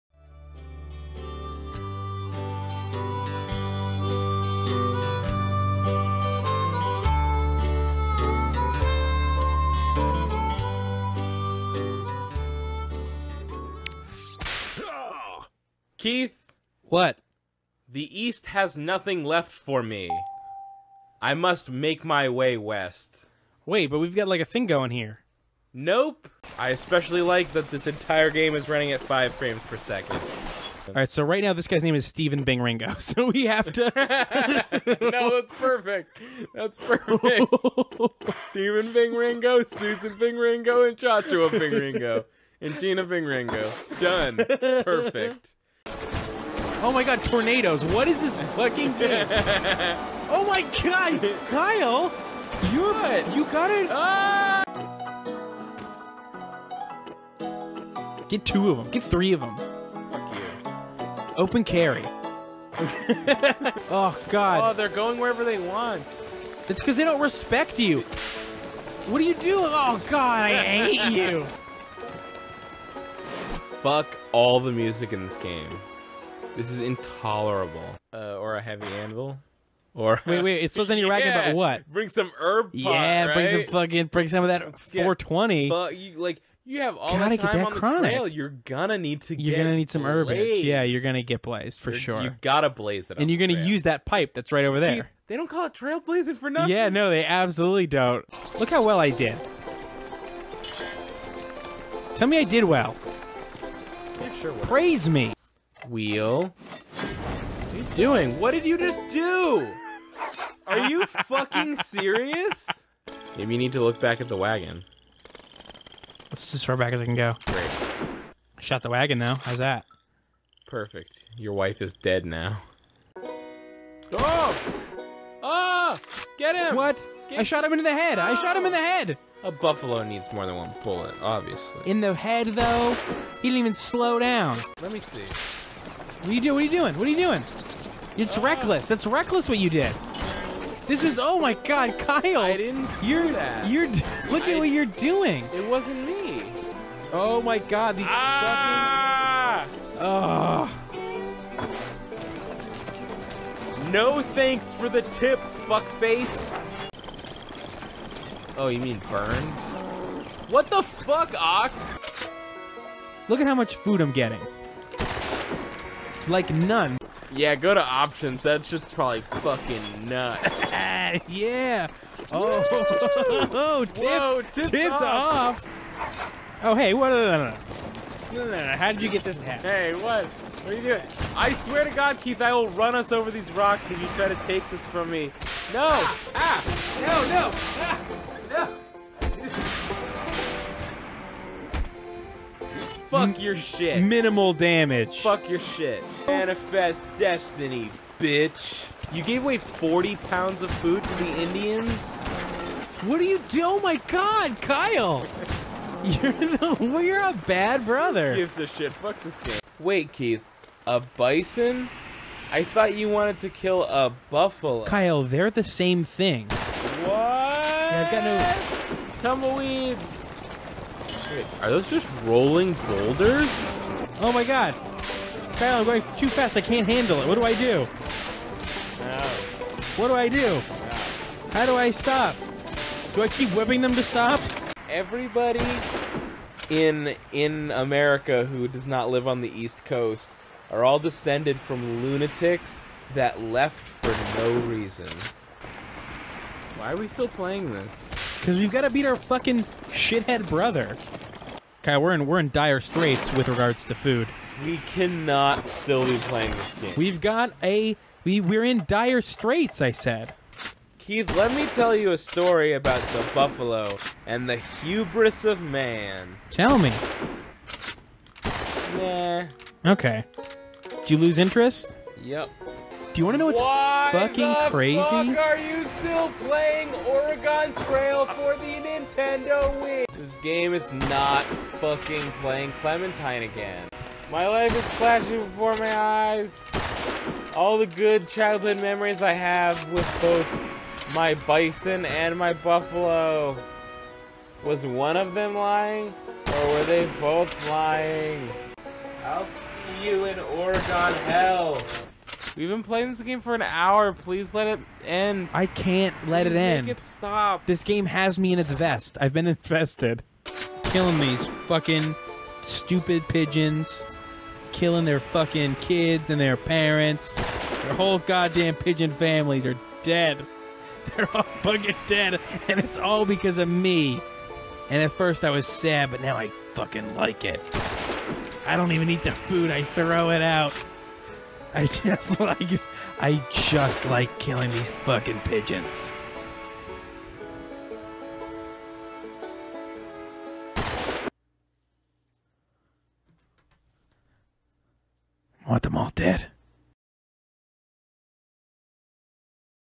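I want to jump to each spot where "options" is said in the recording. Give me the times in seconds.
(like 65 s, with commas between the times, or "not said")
167 s.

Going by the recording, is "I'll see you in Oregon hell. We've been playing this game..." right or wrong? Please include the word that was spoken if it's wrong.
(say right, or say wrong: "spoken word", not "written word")
right.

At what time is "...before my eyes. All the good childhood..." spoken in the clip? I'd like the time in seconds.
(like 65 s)
285 s.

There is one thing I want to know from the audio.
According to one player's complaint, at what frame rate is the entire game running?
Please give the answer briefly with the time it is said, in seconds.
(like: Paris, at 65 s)
5 frames per second, at 28 s.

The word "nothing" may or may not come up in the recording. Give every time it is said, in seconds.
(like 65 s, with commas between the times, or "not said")
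18 s, 96 s.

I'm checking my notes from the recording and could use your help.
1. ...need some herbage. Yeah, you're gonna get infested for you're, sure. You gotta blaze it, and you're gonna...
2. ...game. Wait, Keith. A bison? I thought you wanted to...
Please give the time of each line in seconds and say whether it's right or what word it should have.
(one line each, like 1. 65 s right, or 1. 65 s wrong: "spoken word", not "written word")
1. 89 s wrong: "blazed", not "infested"
2. 209 s right.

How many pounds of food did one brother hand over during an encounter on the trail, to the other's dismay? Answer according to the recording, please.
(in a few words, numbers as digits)
40.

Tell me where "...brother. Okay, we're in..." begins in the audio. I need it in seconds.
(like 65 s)
250 s.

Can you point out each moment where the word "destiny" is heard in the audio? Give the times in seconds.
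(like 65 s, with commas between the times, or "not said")
197 s.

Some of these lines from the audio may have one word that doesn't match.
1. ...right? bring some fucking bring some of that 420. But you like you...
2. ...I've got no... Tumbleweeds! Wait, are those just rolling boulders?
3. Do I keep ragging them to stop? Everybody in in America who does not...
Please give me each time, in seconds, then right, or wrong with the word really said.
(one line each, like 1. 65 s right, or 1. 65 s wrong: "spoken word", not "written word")
1. 83 s right
2. 218 s right
3. 233 s wrong: "whipping", not "ragging".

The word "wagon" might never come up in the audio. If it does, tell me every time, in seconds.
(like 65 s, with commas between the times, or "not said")
114 s, 118 s.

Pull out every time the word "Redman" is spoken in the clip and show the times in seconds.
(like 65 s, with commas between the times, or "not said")
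not said.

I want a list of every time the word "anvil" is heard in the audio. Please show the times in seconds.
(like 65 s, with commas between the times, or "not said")
78 s.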